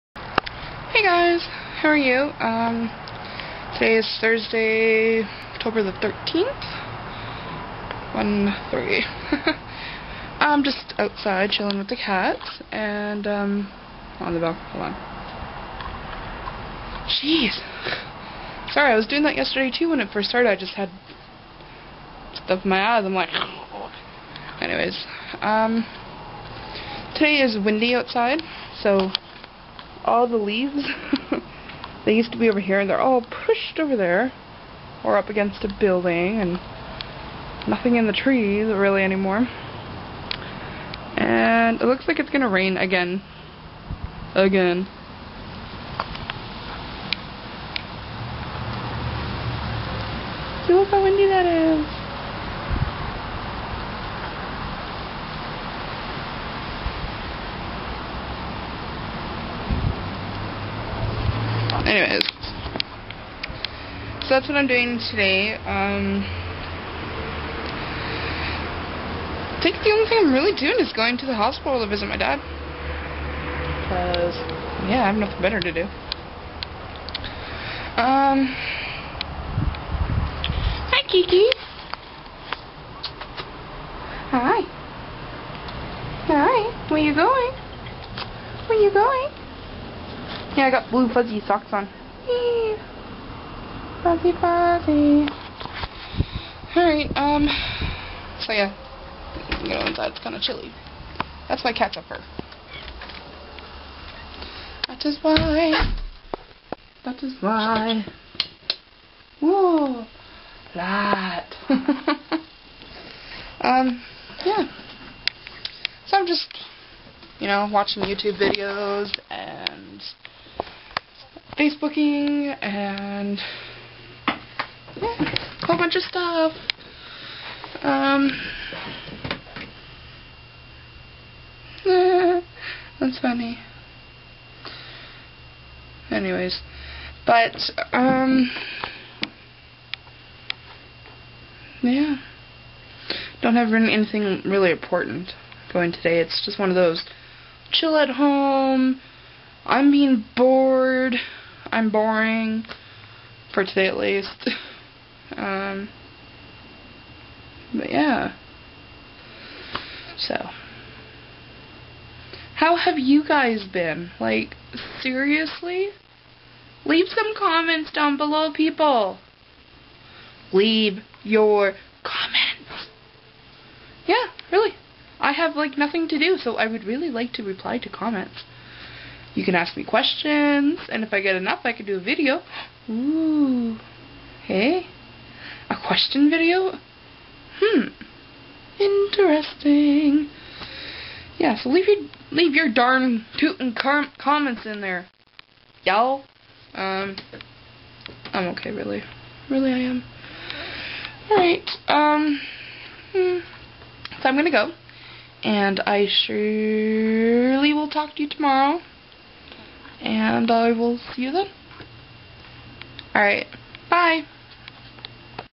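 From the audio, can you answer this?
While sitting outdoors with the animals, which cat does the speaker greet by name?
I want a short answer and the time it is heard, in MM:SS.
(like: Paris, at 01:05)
Kiki, at 01:21.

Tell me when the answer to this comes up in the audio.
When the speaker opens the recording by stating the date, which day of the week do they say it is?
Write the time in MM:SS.
00:04.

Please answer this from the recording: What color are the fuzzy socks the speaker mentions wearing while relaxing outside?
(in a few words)
blue.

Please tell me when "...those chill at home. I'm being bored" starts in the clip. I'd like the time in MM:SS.
02:26.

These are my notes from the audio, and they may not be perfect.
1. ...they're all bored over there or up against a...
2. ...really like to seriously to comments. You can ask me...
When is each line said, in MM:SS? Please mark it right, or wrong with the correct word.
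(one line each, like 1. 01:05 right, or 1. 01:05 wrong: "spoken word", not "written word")
1. 00:32 wrong: "pushed", not "bored"
2. 02:56 wrong: "reply", not "seriously".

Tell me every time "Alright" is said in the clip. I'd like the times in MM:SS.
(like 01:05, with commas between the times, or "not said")
01:36, 03:33.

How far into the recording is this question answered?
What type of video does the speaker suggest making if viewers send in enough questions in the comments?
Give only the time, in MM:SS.
03:05.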